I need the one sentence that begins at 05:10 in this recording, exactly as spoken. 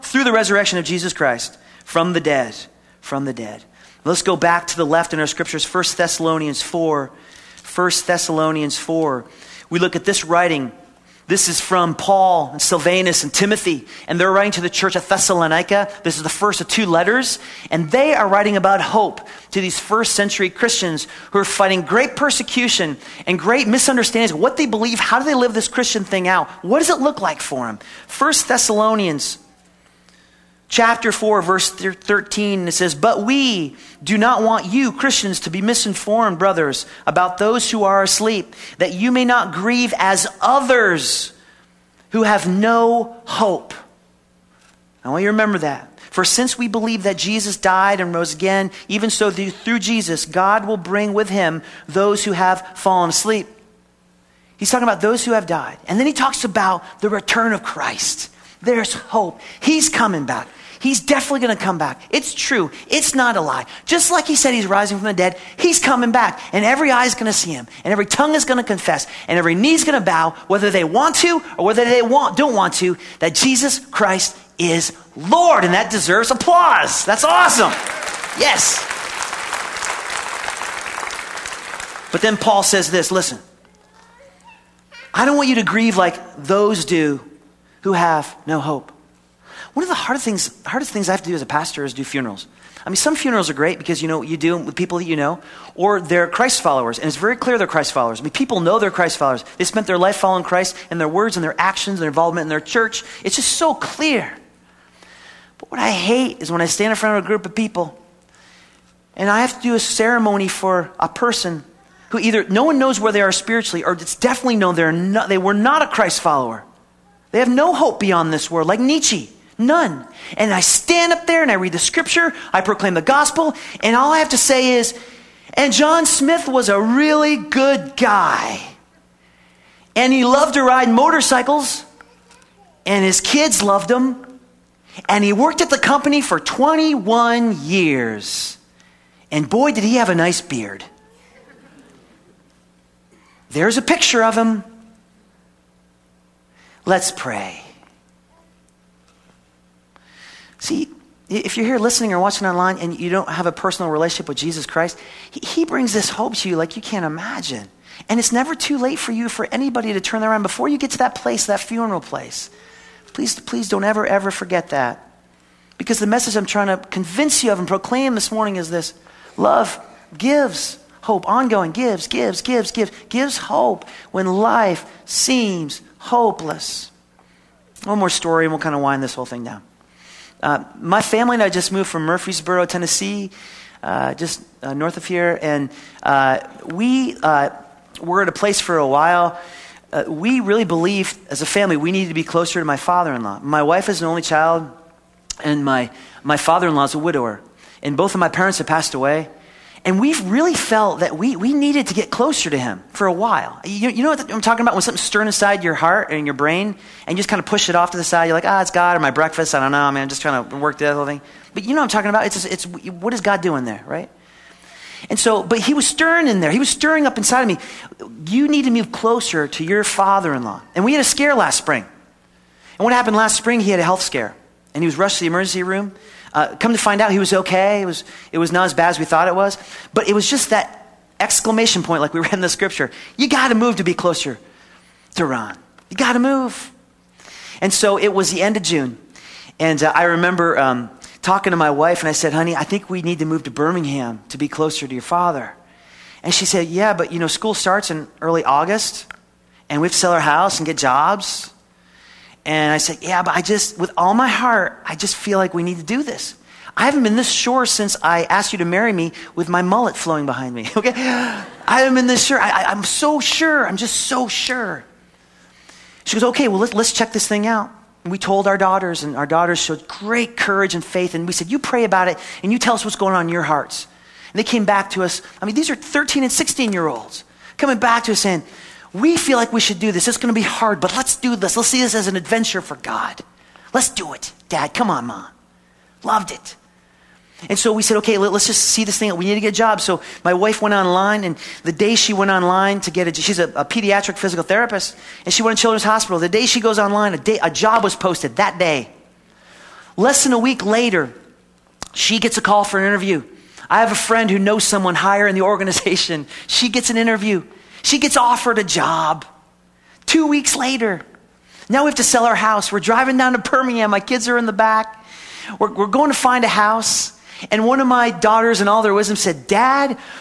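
Two weeks later, now we have to sell our house.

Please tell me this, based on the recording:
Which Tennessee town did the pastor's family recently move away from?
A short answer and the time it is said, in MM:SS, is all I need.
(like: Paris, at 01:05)
Murfreesboro, at 03:02.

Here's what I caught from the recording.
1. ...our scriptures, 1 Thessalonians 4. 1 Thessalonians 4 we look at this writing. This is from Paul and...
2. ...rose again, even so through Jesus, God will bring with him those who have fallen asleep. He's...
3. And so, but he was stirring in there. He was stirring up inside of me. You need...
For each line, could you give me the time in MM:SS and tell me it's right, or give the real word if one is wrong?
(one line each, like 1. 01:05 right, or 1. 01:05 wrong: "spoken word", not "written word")
1. 00:05 right
2. 00:48 right
3. 03:35 right.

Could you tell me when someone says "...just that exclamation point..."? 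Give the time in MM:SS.
03:50.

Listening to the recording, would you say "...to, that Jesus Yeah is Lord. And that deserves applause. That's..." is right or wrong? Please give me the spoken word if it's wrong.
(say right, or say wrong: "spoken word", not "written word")
wrong: "Christ", not "Yeah".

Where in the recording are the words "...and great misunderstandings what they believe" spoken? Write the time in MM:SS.
00:23.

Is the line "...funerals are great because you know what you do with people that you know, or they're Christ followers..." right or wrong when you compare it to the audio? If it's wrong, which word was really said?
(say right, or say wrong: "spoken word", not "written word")
right.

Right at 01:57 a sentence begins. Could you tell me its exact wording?
They have no hope beyond this world, like Nietzsche.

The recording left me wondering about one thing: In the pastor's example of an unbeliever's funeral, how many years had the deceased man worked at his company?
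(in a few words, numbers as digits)
21.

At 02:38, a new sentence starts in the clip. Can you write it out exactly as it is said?
And it's never too late for you, for anybody to turn around before you get to that place, that funeral place.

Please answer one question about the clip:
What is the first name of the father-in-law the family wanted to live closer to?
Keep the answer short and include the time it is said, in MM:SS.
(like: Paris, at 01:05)
Ron, at 03:55.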